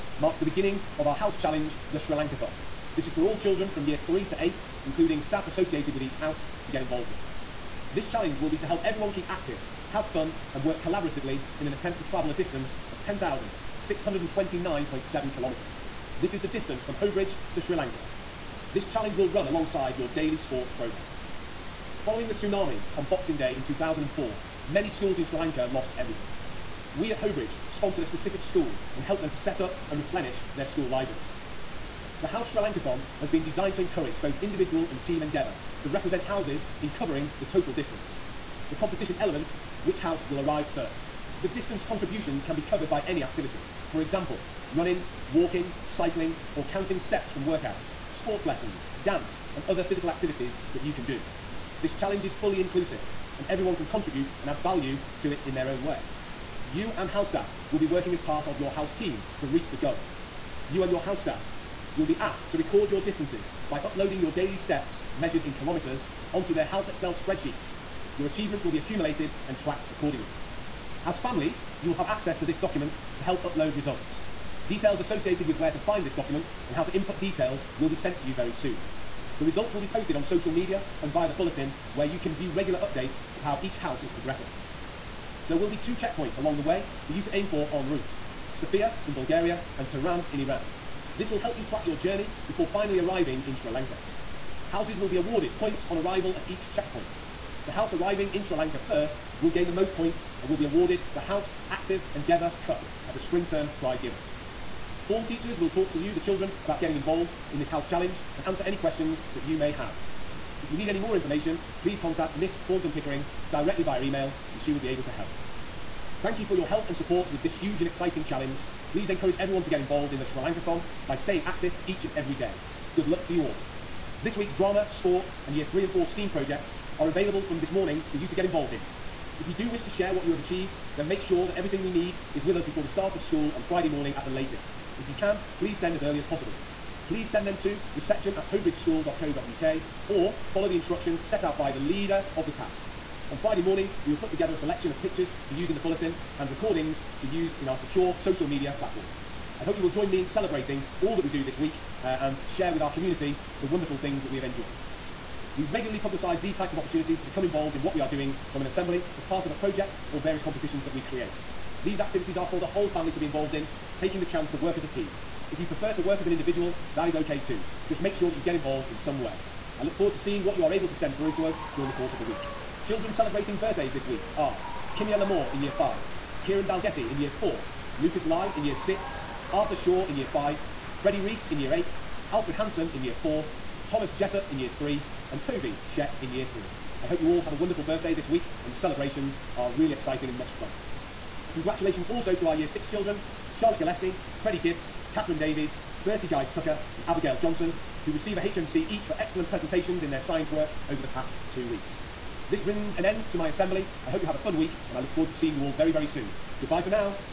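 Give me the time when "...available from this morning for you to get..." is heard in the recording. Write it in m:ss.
2:07.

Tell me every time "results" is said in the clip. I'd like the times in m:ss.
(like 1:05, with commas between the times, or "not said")
1:13, 1:19.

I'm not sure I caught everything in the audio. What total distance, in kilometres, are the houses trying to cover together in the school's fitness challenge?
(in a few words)
10,629.7 kilometres.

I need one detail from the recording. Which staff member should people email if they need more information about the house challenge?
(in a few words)
Miss Thornton Pickering.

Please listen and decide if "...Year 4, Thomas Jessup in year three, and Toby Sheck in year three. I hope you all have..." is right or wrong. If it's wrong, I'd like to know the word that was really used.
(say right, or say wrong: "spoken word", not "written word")
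right.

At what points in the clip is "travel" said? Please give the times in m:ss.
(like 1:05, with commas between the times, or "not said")
0:12.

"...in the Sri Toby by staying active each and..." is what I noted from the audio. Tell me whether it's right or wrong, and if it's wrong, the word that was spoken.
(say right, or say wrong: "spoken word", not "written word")
wrong: "Lankathon", not "Toby".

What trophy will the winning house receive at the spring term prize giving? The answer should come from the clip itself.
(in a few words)
House Active Endeavour Cup.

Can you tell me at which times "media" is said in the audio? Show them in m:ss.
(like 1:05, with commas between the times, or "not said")
1:20, 2:28.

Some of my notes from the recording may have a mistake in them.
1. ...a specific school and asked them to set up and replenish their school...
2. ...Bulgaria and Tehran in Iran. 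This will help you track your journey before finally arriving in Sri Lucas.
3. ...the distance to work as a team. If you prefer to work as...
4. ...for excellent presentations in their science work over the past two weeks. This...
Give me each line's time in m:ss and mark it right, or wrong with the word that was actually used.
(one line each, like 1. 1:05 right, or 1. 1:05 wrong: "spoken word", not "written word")
1. 0:28 wrong: "helped", not "asked"
2. 1:29 wrong: "Lanka", not "Lucas"
3. 2:44 wrong: "chance", not "distance"
4. 3:19 right.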